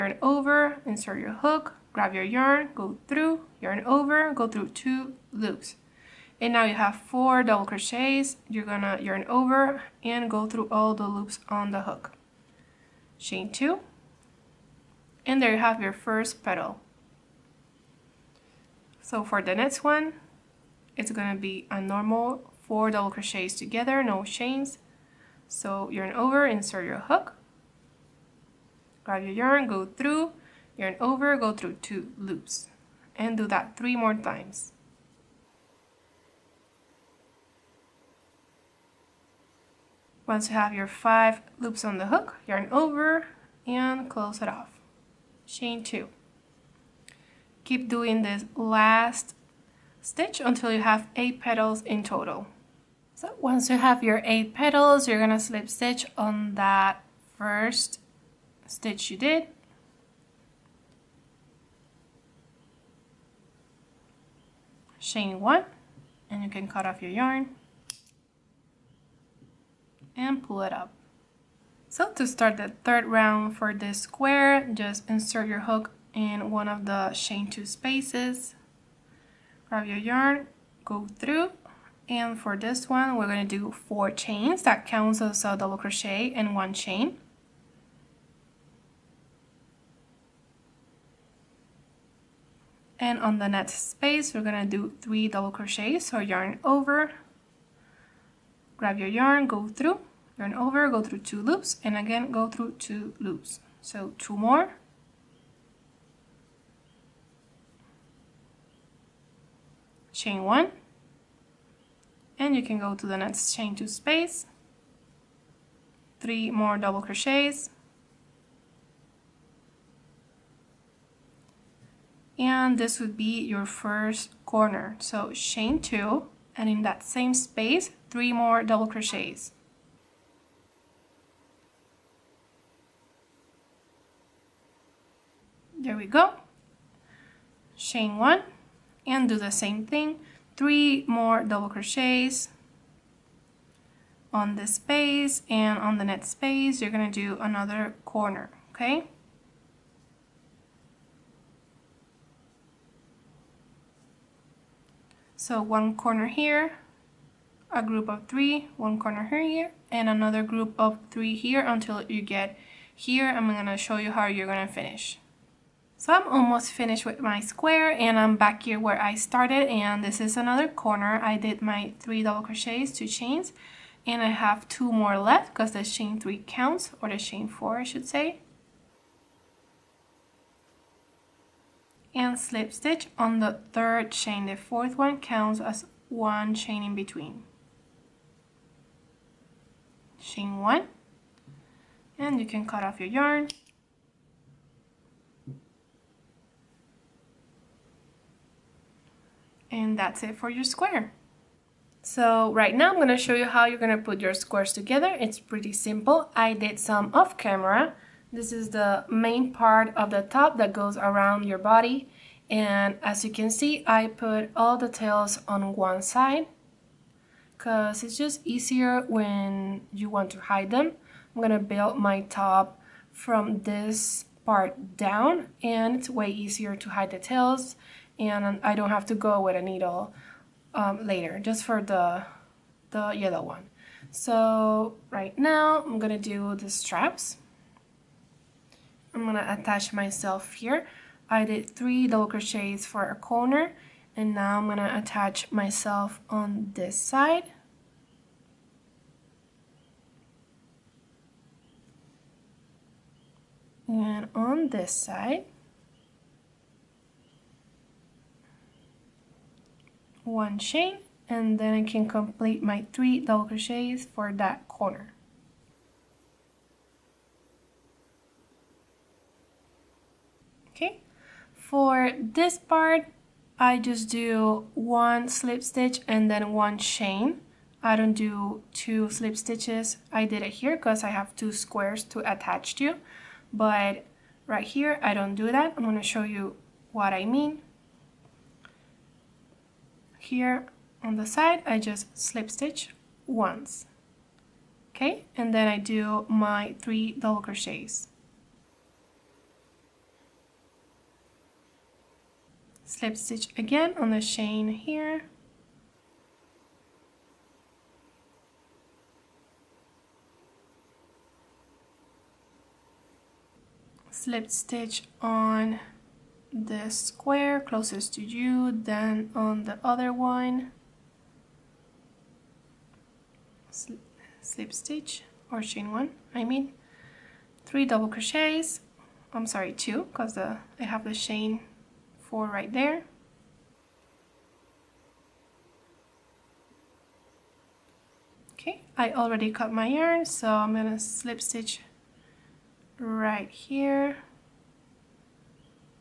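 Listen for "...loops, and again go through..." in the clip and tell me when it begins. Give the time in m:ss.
1:41.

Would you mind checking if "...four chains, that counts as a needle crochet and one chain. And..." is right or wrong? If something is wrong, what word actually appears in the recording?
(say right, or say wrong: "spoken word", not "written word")
wrong: "double", not "needle".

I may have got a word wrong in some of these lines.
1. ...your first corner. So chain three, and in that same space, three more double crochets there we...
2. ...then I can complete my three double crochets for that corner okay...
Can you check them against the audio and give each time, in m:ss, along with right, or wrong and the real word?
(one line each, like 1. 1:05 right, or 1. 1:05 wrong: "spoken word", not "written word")
1. 2:03 wrong: "two", not "three"
2. 4:21 right.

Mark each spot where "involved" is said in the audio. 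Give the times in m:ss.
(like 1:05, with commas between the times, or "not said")
not said.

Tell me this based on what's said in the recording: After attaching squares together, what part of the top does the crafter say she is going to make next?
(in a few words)
the straps.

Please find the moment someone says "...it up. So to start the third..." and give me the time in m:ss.
1:10.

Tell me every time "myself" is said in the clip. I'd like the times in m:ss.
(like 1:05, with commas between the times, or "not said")
3:59, 4:05.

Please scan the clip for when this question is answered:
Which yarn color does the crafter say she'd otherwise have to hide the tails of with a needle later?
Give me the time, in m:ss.
3:53.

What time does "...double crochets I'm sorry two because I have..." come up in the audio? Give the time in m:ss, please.
5:27.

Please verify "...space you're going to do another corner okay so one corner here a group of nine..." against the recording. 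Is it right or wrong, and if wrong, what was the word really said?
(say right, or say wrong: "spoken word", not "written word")
wrong: "three", not "nine".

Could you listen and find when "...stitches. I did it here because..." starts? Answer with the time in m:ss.
4:39.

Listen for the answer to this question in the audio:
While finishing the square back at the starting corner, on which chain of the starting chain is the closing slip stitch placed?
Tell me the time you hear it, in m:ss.
3:03.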